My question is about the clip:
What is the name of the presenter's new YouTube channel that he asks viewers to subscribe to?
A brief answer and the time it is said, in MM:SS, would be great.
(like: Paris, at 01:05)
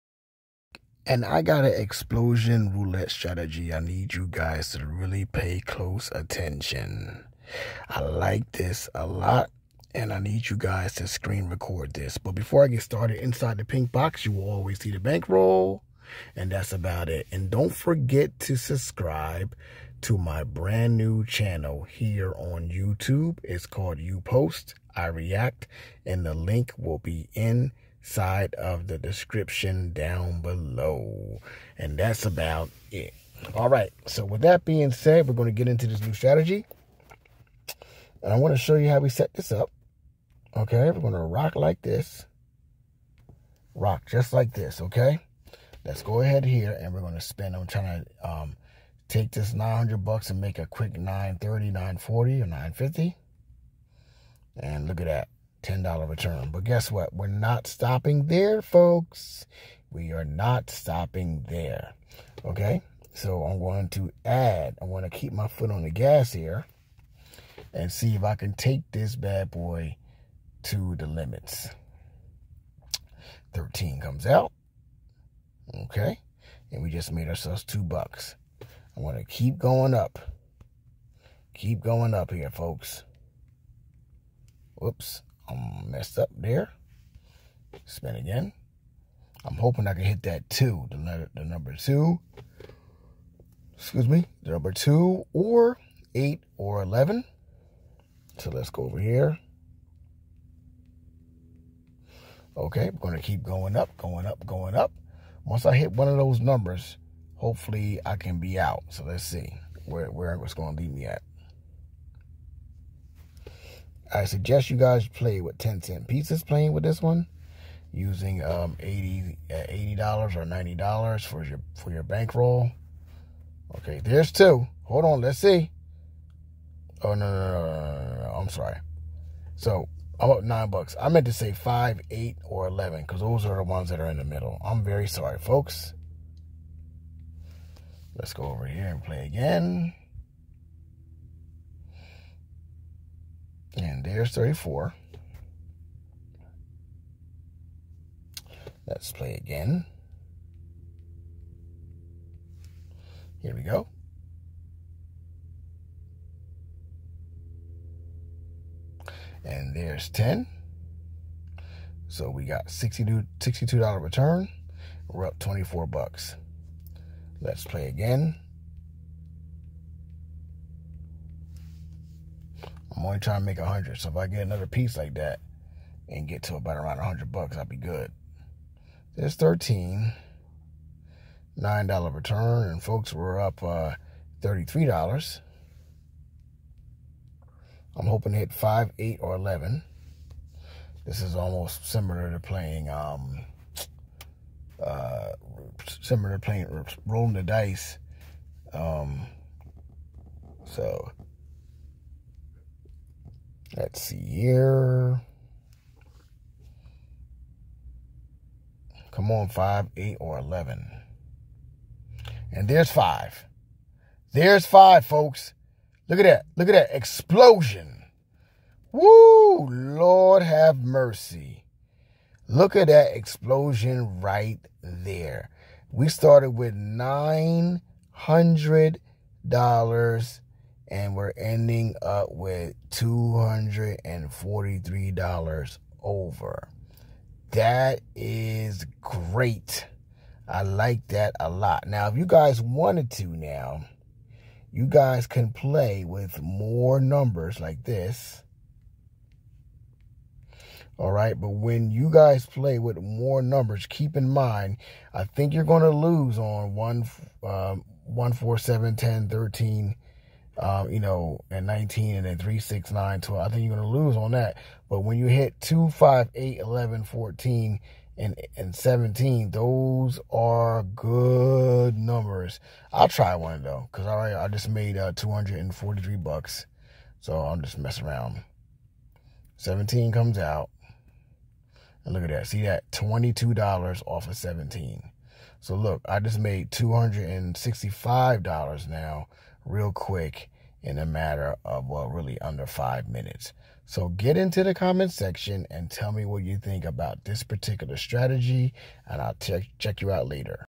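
You Post, I React, at 00:23.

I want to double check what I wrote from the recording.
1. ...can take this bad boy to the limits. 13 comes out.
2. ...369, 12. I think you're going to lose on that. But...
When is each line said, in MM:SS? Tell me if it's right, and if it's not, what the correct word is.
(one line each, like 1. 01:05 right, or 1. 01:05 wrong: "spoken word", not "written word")
1. 01:08 right
2. 04:22 right.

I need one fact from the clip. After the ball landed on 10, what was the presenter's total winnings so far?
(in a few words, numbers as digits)
$24.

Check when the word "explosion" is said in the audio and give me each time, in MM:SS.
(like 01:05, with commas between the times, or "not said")
00:01, 03:36, 03:43.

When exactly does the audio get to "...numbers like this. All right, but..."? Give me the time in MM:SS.
04:06.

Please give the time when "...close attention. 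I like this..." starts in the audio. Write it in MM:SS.
00:05.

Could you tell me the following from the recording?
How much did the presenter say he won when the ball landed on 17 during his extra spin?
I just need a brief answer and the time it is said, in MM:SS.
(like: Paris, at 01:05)
$22, at 04:42.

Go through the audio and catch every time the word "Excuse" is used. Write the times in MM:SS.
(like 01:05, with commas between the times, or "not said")
01:33.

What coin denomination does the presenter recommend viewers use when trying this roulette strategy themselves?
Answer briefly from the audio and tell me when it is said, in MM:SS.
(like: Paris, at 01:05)
10 cent pieces, at 01:55.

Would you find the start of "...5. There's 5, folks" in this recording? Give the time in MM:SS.
03:32.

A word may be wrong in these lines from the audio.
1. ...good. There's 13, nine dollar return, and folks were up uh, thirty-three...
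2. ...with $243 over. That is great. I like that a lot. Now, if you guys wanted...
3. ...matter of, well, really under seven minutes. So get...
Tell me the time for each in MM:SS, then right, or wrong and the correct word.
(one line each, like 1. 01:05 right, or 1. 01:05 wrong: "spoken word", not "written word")
1. 02:57 right
2. 03:52 right
3. 04:51 wrong: "five", not "seven".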